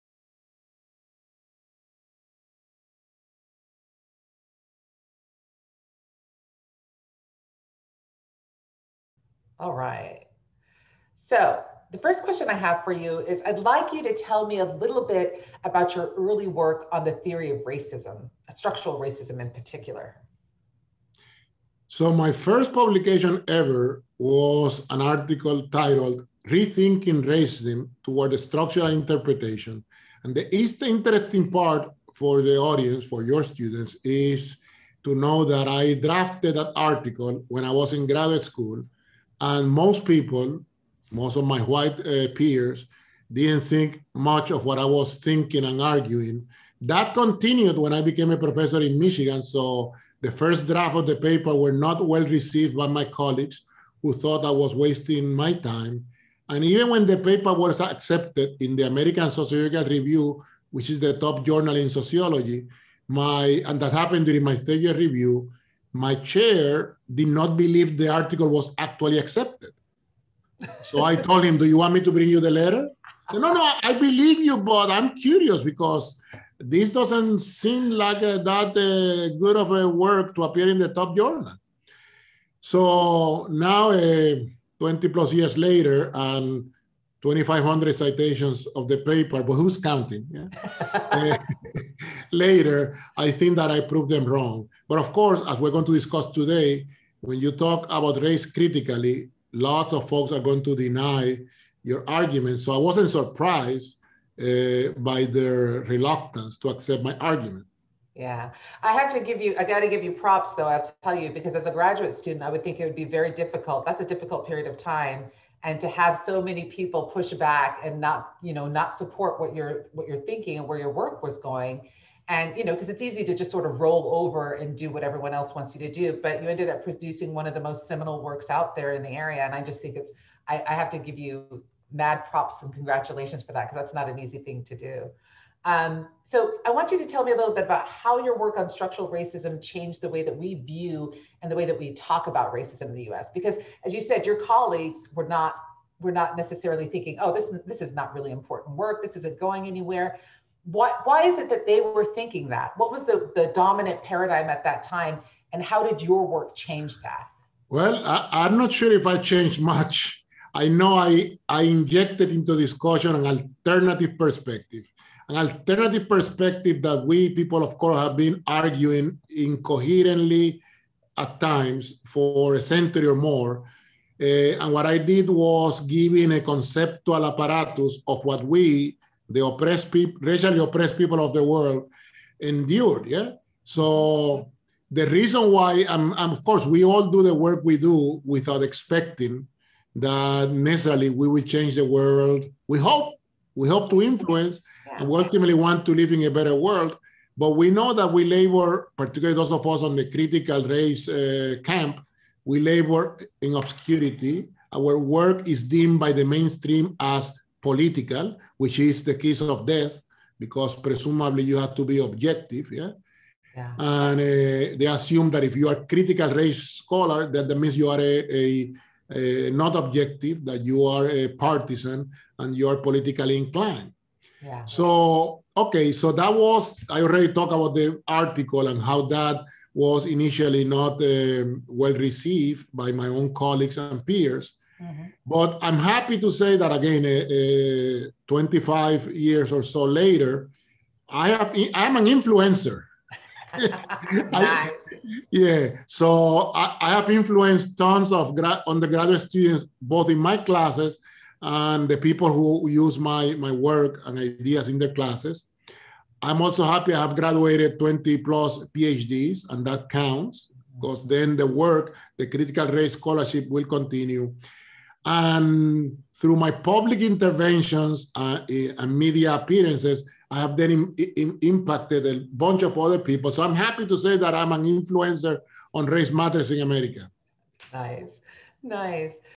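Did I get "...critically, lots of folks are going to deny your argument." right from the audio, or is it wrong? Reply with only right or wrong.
right.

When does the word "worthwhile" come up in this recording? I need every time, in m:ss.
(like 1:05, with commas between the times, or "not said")
not said.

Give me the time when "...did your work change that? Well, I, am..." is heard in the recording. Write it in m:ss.
2:35.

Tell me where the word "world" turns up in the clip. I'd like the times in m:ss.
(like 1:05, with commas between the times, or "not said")
3:01, 3:11, 3:16.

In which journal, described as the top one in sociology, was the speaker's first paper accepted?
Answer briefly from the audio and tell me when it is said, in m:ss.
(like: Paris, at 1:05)
American Sociological Review, at 0:58.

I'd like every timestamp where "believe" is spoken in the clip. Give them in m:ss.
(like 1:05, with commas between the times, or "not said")
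1:07, 1:13.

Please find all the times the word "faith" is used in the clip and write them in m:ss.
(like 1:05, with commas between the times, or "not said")
not said.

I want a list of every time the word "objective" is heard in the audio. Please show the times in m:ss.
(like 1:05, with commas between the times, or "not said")
3:31, 3:39.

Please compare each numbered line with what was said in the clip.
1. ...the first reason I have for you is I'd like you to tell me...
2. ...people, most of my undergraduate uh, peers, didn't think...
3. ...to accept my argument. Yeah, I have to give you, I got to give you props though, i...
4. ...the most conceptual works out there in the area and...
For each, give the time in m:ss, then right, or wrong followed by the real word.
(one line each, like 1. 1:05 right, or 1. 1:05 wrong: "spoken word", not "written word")
1. 0:11 wrong: "question", not "reason"
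2. 0:40 wrong: "white", not "undergraduate"
3. 1:46 right
4. 2:07 wrong: "seminal", not "conceptual".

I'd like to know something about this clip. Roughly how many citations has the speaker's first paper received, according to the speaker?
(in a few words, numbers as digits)
2,500.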